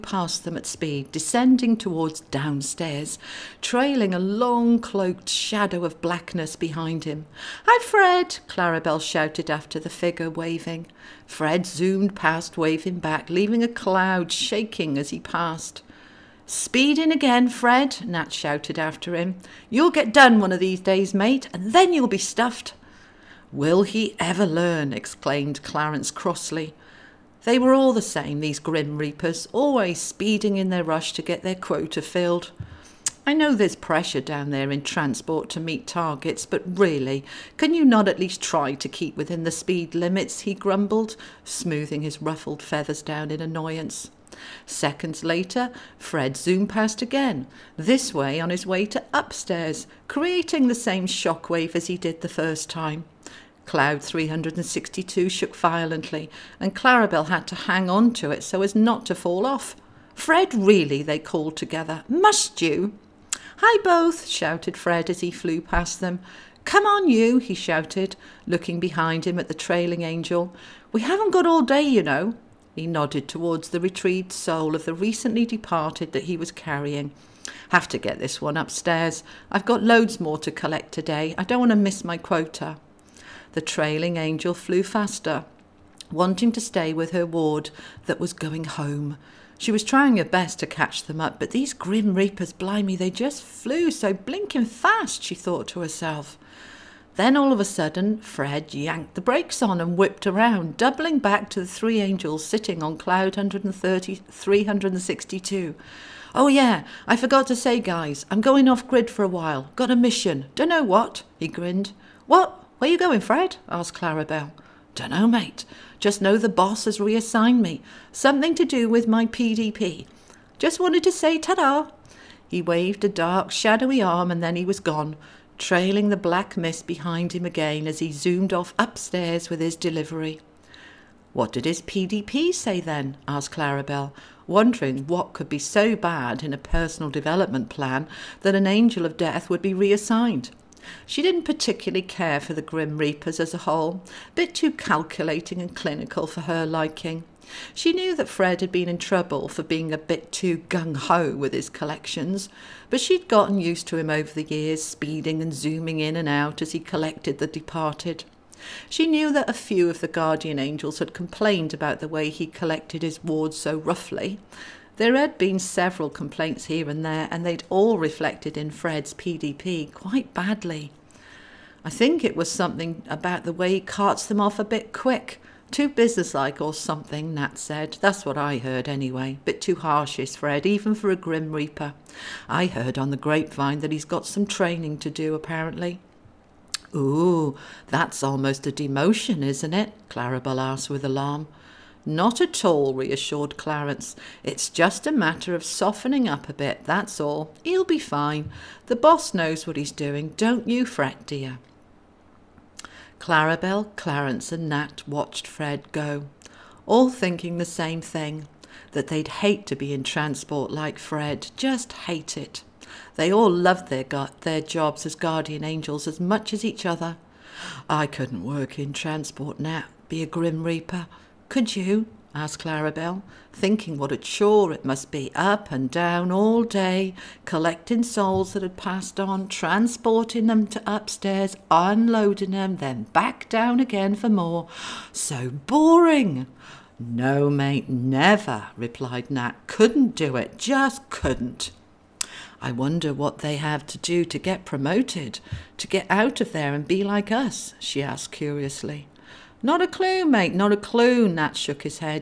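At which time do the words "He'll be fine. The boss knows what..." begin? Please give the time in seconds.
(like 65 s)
197 s.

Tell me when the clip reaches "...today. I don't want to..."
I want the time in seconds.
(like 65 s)
80 s.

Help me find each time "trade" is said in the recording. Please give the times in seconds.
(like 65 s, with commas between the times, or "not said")
not said.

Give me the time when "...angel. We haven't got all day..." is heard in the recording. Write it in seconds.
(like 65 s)
70 s.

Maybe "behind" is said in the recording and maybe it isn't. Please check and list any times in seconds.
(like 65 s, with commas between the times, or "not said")
6 s, 68 s, 126 s.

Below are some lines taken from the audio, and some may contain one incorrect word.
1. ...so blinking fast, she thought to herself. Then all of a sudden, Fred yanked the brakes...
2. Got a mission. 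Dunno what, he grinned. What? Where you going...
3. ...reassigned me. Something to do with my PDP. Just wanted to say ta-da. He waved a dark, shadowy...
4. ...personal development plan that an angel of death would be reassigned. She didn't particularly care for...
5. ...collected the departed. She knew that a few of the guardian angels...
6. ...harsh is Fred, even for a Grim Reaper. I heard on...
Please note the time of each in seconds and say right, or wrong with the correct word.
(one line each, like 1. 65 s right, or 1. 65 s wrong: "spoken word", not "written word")
1. 93 s right
2. 109 s right
3. 116 s right
4. 136 s right
5. 156 s right
6. 179 s right.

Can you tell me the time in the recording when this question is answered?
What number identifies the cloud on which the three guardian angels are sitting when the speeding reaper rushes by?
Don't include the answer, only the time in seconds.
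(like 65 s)
53 s.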